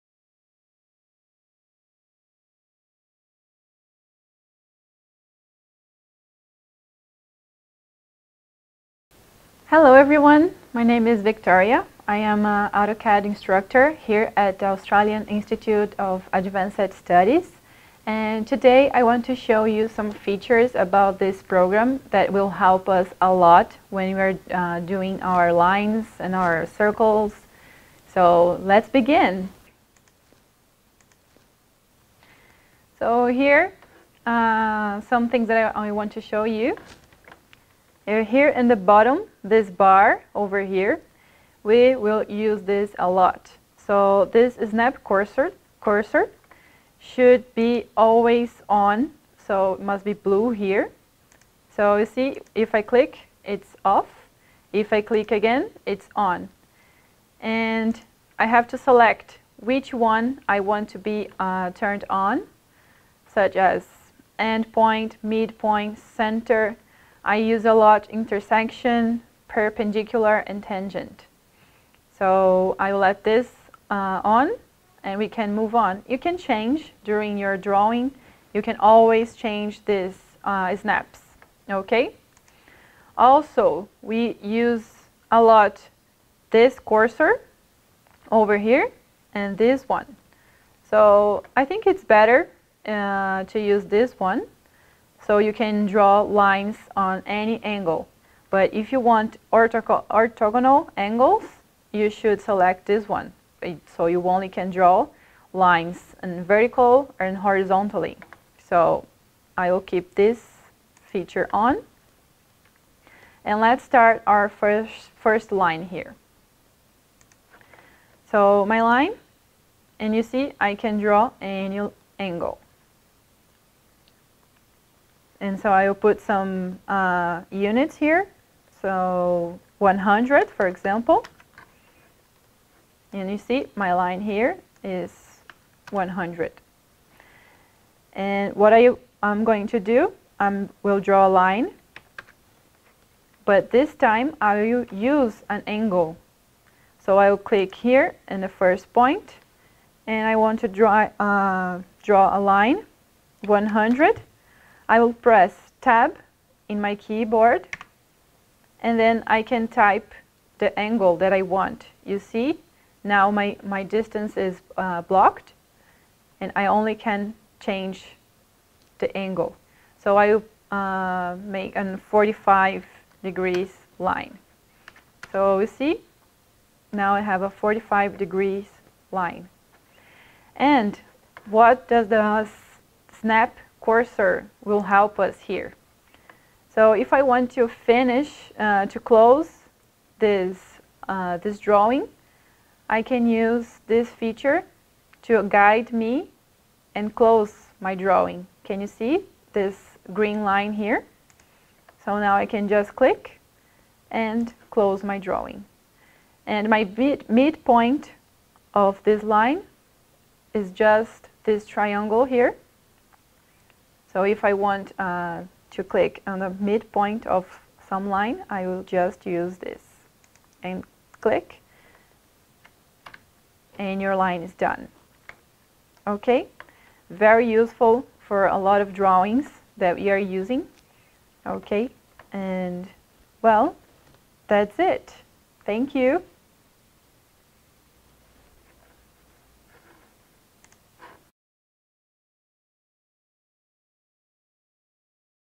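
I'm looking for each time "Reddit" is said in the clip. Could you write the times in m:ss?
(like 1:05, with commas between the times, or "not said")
not said.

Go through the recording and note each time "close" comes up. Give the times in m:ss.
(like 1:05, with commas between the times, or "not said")
3:08, 3:17, 3:24.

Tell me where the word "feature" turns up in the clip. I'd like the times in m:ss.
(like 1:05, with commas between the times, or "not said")
0:20, 1:51, 3:14.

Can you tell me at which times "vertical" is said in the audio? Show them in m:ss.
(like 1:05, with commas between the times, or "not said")
1:46.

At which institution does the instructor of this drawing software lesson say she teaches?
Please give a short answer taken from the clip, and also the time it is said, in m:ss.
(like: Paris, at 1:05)
Australian Institute of Advanced Studies, at 0:14.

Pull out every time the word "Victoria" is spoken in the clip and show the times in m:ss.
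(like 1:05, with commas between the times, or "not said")
0:11.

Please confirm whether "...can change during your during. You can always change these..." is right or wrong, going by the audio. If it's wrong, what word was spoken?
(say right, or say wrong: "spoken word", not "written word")
wrong: "drawing", not "during".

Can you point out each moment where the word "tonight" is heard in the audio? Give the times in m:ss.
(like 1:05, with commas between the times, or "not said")
not said.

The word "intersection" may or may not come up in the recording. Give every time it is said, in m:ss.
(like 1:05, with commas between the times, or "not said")
1:08.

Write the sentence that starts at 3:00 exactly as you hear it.
And what does the snap cursor will help us here.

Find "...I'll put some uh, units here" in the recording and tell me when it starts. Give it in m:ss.
2:05.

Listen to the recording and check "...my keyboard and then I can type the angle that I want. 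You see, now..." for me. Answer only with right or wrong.
right.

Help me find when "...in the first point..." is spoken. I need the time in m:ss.
2:28.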